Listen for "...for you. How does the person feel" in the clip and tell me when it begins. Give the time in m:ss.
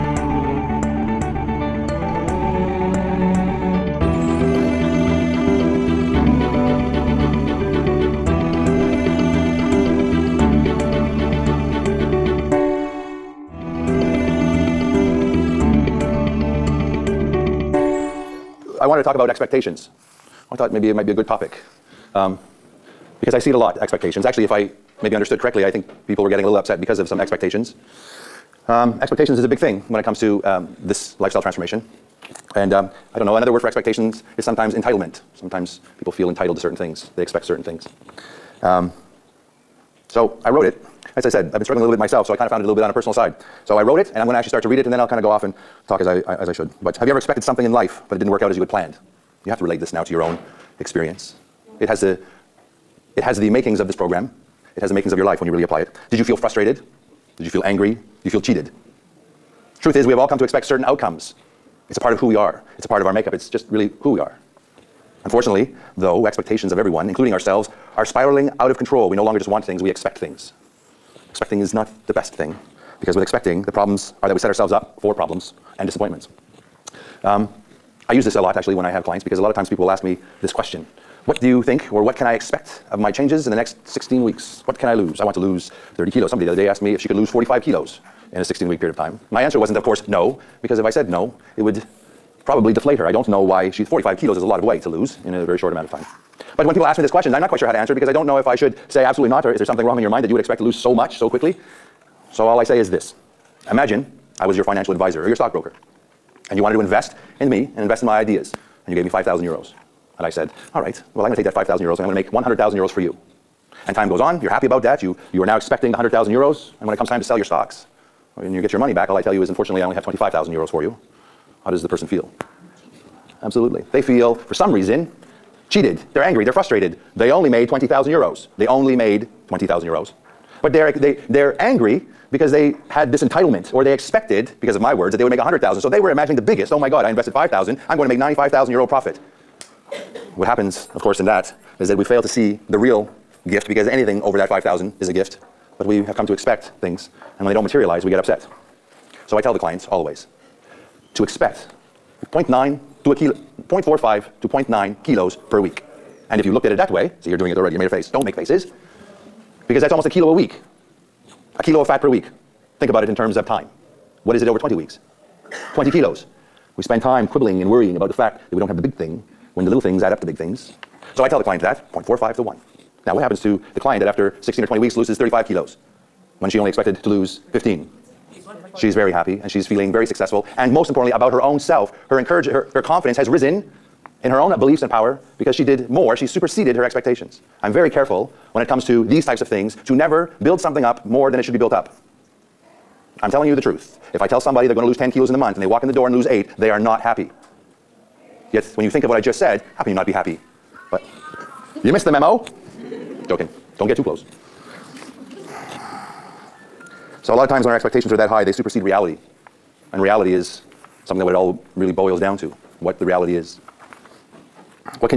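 2:00.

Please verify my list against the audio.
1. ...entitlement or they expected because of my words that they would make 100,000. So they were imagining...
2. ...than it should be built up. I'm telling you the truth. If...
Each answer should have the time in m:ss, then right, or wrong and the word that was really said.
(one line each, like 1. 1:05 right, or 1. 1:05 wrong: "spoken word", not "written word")
1. 2:13 right
2. 3:11 right.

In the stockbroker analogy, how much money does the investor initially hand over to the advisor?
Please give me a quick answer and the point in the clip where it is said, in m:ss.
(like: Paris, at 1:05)
5,000 euros, at 1:48.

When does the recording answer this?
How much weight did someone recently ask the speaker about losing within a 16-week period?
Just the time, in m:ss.
1:27.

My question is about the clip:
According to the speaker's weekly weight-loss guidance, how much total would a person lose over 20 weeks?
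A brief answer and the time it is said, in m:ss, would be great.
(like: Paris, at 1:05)
20 kilos, at 2:45.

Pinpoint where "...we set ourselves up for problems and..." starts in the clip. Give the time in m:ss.
1:14.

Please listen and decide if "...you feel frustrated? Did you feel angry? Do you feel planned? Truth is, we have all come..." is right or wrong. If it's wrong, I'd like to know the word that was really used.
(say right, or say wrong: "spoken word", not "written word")
wrong: "cheated", not "planned".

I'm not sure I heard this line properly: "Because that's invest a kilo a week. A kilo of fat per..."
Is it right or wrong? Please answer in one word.
wrong.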